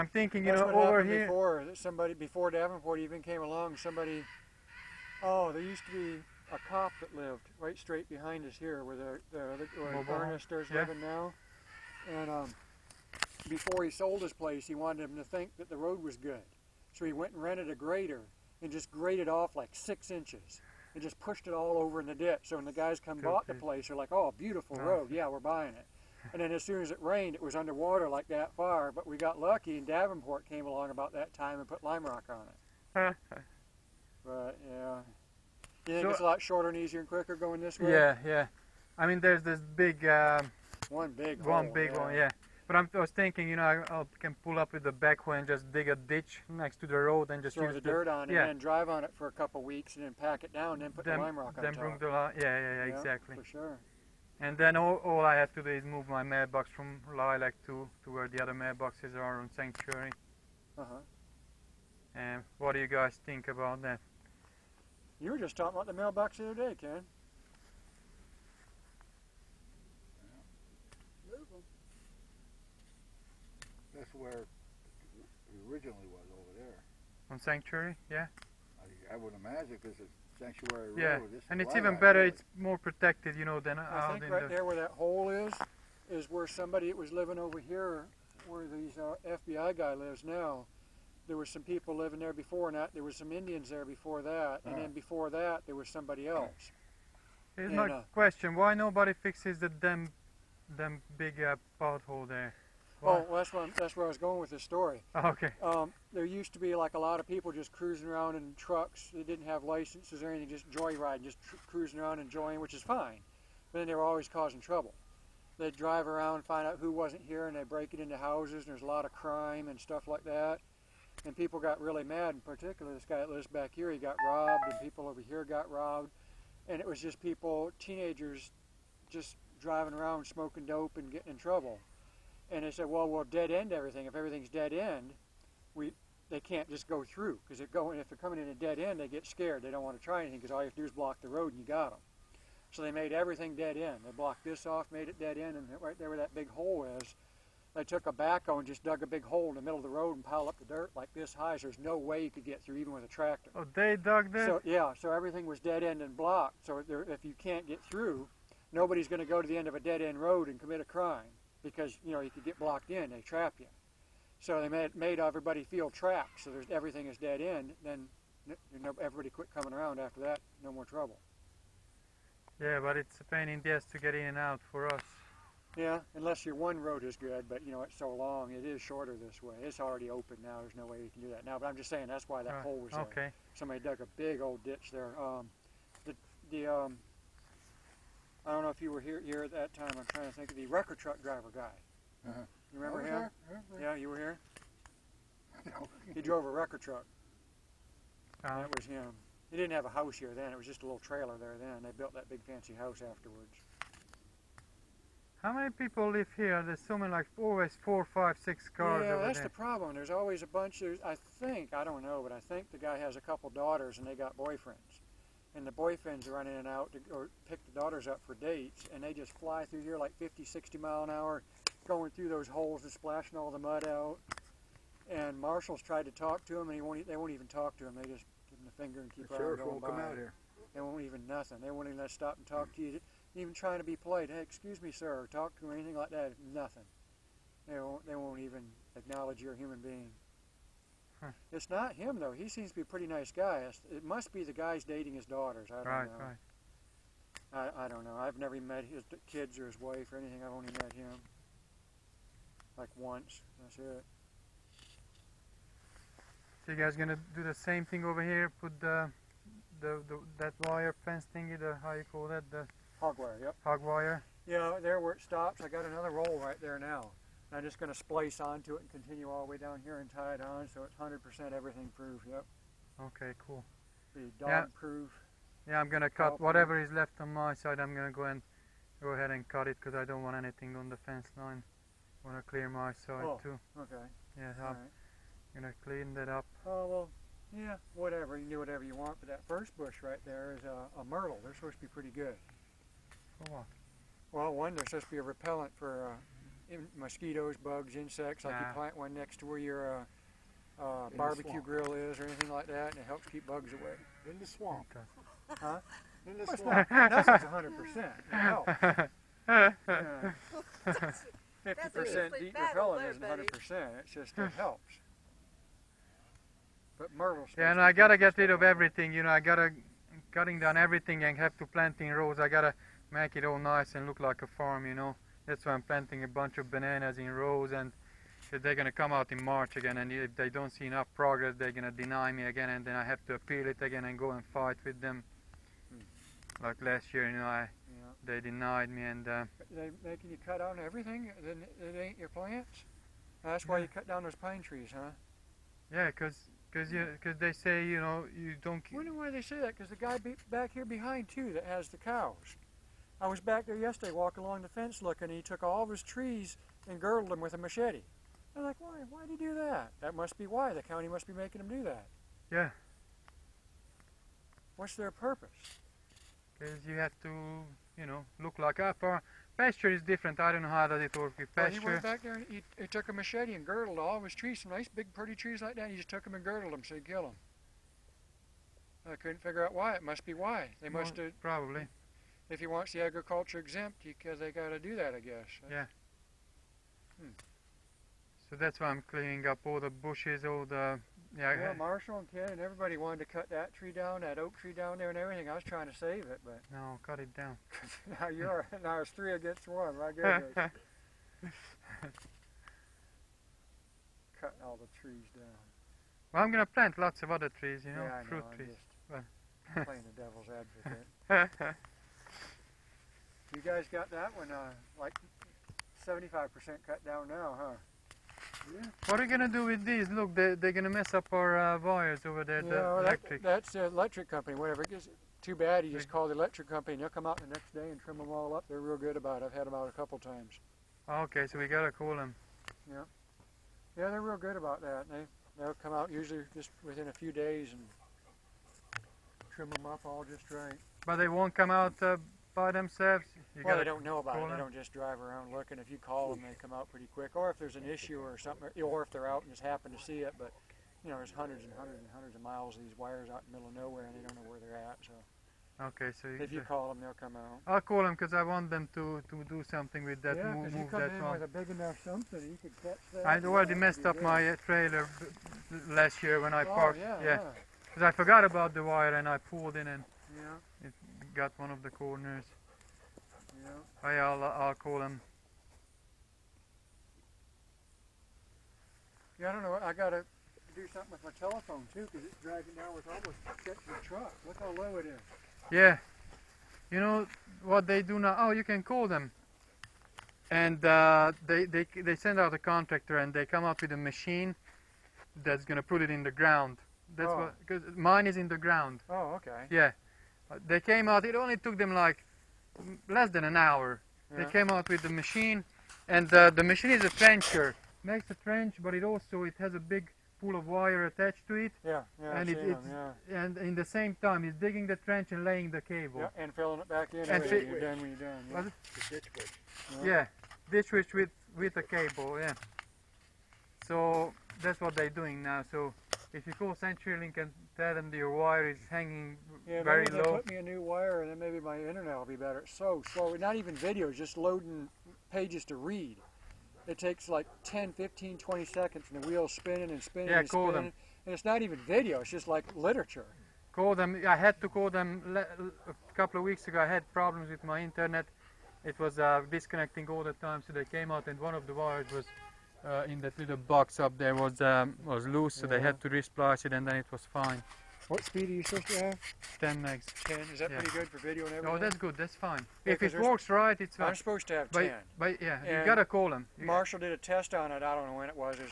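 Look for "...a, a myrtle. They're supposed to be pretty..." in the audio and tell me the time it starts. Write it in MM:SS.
04:50.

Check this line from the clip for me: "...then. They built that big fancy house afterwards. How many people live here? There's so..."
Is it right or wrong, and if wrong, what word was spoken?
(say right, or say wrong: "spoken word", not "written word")
right.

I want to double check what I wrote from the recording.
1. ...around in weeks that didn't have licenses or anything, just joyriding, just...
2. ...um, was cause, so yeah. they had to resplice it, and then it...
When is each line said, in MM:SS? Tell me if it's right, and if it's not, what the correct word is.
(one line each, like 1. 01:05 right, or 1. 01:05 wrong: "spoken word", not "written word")
1. 01:48 wrong: "trucks", not "weeks"
2. 09:14 wrong: "loose", not "cause".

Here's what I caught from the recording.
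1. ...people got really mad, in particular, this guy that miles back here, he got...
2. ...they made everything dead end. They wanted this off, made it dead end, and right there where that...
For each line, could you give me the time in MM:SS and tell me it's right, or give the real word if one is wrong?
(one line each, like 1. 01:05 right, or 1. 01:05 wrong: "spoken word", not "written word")
1. 02:01 wrong: "lives", not "miles"
2. 02:22 wrong: "blocked", not "wanted".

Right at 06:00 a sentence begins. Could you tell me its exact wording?
The county must be making him do that.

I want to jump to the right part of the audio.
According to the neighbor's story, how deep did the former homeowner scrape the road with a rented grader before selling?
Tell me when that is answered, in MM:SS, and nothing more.
00:19.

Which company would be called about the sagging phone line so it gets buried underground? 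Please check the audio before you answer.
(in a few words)
CenturyLink.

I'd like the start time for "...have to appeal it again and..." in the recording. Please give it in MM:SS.
05:33.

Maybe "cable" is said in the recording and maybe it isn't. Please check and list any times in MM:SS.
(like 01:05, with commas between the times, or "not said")
08:35, 08:41.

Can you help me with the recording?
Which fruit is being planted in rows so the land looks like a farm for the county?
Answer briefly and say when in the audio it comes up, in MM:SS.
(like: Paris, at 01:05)
bananas, at 05:26.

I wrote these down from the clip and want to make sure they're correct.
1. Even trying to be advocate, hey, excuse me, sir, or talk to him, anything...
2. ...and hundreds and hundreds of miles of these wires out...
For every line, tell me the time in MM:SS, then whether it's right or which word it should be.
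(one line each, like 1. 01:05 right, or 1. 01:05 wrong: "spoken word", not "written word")
1. 03:53 wrong: "polite", not "advocate"
2. 07:31 right.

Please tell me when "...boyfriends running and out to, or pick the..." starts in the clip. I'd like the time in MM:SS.
03:35.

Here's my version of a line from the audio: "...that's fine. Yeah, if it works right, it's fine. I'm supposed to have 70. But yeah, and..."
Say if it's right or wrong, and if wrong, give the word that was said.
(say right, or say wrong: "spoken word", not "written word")
wrong: "10", not "70".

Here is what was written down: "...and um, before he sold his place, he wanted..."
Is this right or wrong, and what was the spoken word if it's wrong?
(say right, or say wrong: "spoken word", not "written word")
right.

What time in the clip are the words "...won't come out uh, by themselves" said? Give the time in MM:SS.
07:21.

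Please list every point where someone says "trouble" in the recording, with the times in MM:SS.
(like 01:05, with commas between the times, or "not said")
01:54, 02:11, 02:50.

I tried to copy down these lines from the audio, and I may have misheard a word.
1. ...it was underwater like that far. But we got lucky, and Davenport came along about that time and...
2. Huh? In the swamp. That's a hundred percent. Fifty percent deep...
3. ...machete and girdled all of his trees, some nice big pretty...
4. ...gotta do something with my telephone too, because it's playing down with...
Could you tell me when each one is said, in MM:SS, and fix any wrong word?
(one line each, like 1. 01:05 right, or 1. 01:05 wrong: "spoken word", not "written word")
1. 00:27 right
2. 05:05 right
3. 06:13 right
4. 07:59 wrong: "dragging", not "playing".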